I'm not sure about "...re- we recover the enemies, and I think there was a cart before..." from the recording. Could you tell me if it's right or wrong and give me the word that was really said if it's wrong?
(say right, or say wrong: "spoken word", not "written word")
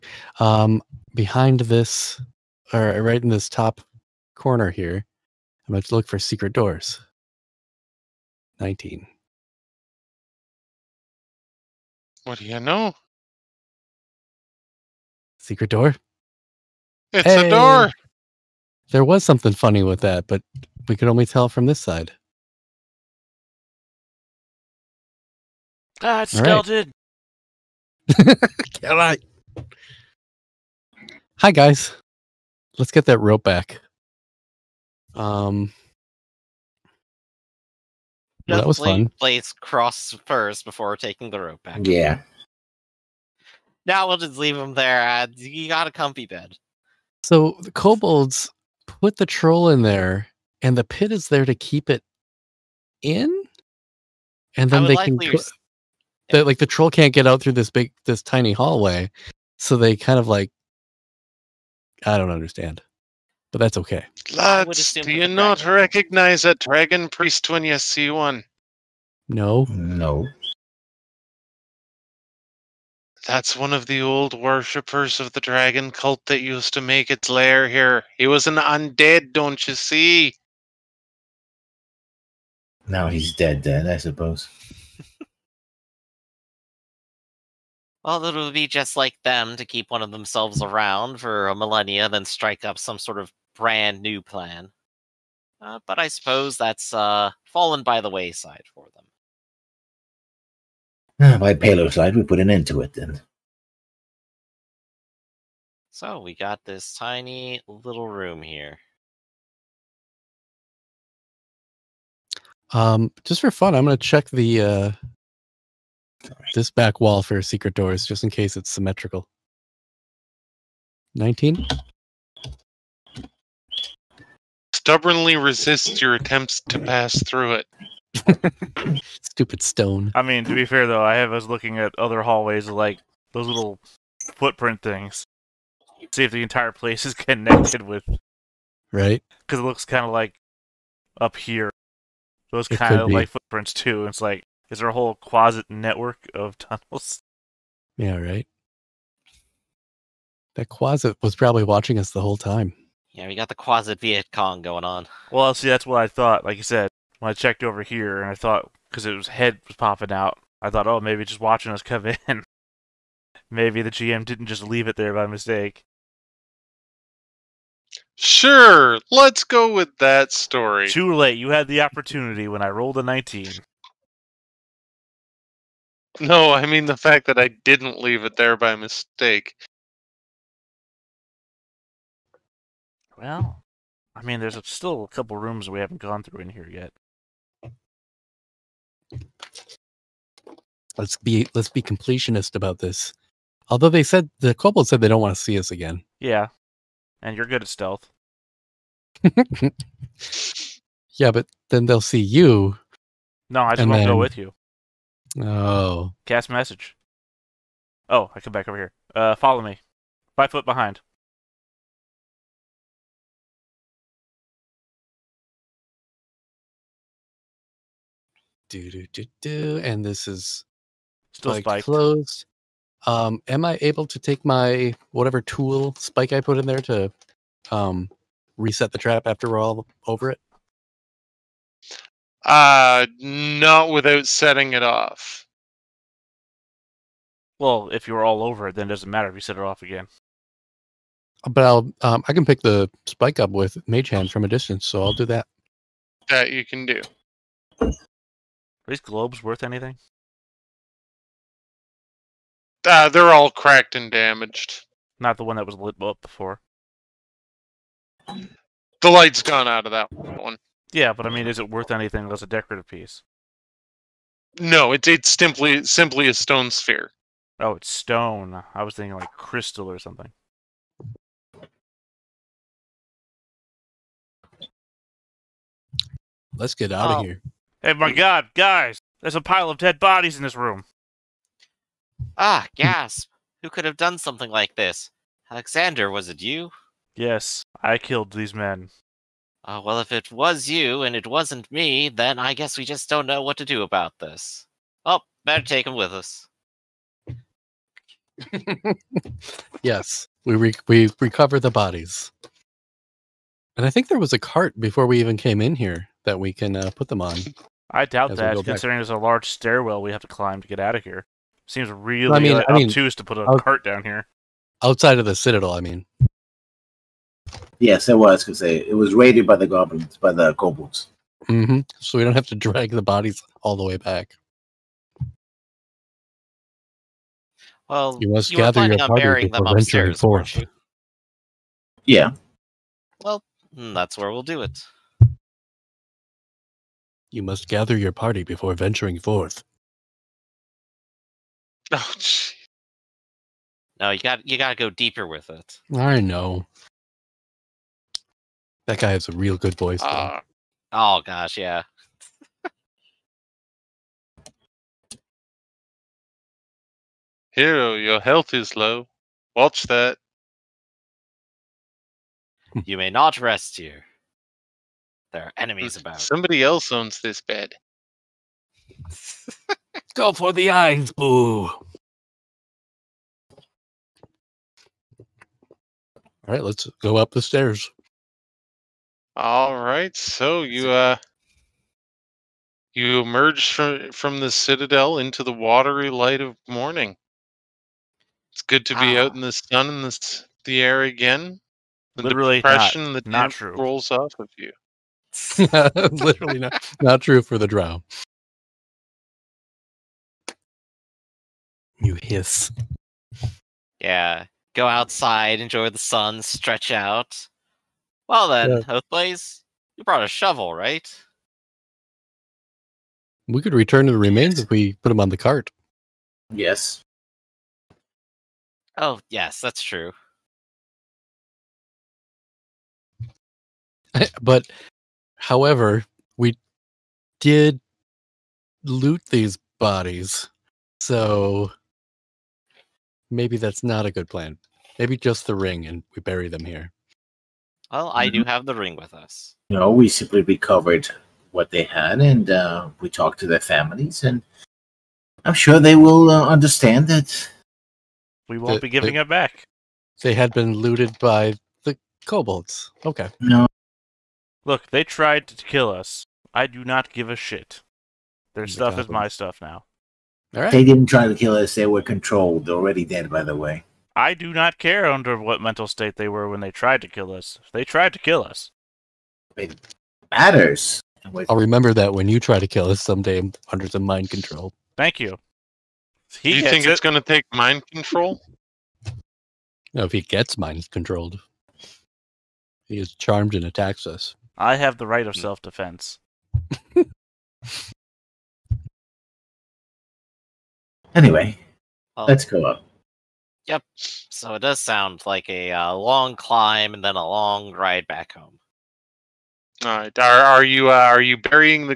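wrong: "bodies", not "enemies".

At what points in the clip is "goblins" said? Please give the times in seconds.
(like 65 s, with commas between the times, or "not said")
319 s, 458 s.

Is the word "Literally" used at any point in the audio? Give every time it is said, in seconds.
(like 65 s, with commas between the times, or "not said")
392 s, 396 s.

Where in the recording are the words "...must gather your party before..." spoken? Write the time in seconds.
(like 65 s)
337 s.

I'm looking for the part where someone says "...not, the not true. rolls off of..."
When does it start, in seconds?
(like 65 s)
393 s.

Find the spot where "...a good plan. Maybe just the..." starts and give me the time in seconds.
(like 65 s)
434 s.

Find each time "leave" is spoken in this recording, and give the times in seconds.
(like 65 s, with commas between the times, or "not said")
44 s, 164 s, 178 s.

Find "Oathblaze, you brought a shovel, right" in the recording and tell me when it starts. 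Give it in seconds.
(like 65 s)
409 s.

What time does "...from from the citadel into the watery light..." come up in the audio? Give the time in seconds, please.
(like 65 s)
383 s.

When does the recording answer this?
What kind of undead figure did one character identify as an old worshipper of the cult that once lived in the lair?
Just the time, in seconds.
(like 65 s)
66 s.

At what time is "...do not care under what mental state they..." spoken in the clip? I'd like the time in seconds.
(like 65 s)
464 s.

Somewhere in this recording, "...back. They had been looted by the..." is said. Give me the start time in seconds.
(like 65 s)
449 s.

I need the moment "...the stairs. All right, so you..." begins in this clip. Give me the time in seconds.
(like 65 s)
377 s.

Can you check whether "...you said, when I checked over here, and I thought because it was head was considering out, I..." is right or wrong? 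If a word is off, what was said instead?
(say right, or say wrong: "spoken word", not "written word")
wrong: "popping", not "considering".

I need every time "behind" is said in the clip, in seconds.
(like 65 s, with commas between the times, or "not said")
1 s, 210 s.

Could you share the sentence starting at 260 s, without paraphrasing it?
Yeah, but I mean, is it worth anything As a decorative piece?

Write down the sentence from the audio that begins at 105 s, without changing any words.
So we got this tiny little room here.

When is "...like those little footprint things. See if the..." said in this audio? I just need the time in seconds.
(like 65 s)
132 s.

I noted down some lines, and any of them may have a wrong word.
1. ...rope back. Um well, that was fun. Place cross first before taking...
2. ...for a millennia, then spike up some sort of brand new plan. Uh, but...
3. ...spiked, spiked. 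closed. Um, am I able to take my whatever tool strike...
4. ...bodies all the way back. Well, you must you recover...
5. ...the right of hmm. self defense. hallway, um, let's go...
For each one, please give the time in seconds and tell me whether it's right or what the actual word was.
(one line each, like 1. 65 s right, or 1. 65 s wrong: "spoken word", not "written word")
1. 33 s right
2. 91 s wrong: "strike", not "spike"
3. 221 s wrong: "spike", not "strike"
4. 323 s wrong: "gather", not "recover"
5. 484 s wrong: "anyway", not "hallway".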